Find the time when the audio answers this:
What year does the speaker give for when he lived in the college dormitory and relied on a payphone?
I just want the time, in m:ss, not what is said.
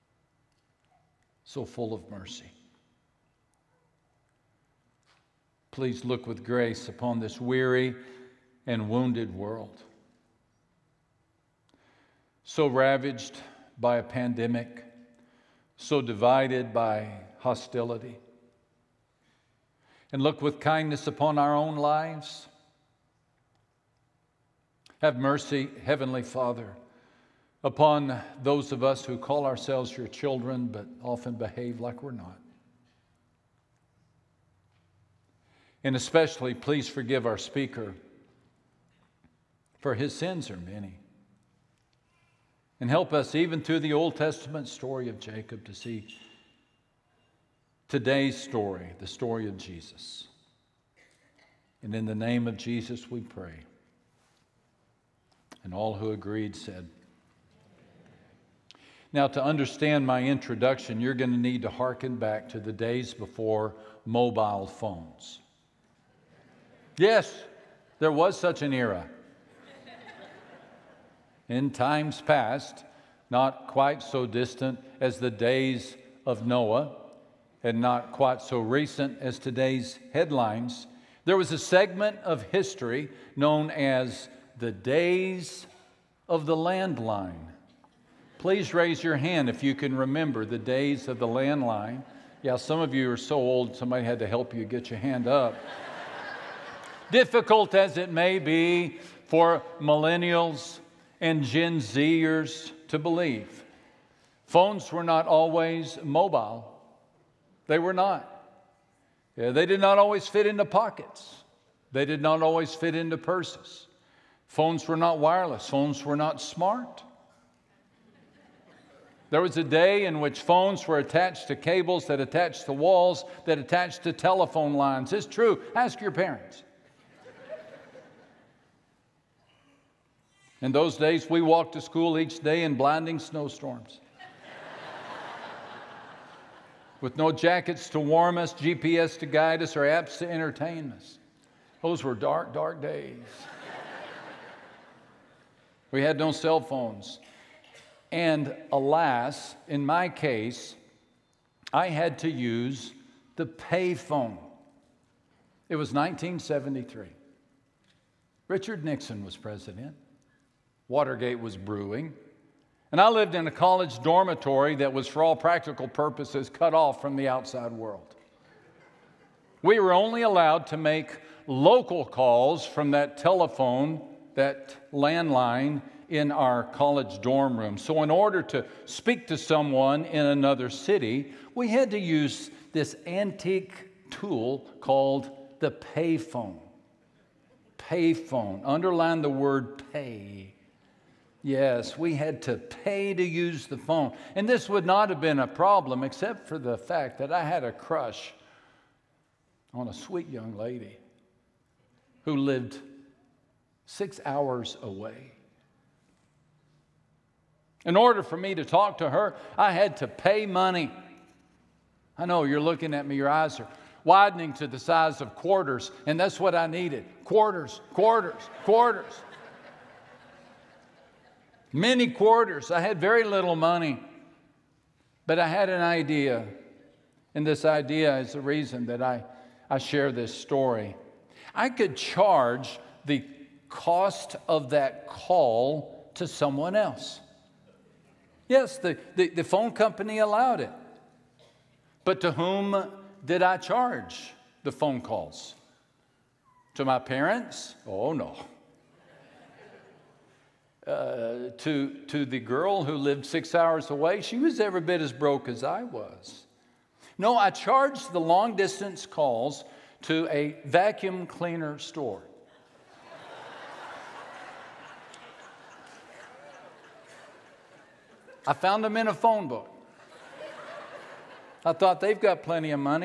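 2:35.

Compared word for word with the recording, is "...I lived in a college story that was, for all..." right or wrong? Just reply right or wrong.
wrong.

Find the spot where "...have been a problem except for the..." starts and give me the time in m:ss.
3:15.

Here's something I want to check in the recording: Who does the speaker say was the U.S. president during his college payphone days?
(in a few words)
Richard Nixon.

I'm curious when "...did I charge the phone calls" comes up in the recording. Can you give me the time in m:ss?
4:03.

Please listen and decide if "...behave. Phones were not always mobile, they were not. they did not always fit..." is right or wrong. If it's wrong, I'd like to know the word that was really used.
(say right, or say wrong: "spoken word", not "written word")
wrong: "believe", not "behave".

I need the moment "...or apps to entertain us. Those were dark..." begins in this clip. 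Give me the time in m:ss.
2:19.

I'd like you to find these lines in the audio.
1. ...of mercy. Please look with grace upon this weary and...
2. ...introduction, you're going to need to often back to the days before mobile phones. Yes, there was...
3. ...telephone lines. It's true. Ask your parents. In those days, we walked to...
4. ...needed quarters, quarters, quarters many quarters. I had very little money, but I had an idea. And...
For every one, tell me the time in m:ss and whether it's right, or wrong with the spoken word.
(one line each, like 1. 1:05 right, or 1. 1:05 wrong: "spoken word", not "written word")
1. 0:01 right
2. 1:00 wrong: "hearken", not "often"
3. 2:04 right
4. 3:36 right.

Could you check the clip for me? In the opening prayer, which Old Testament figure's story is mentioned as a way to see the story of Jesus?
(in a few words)
Jacob.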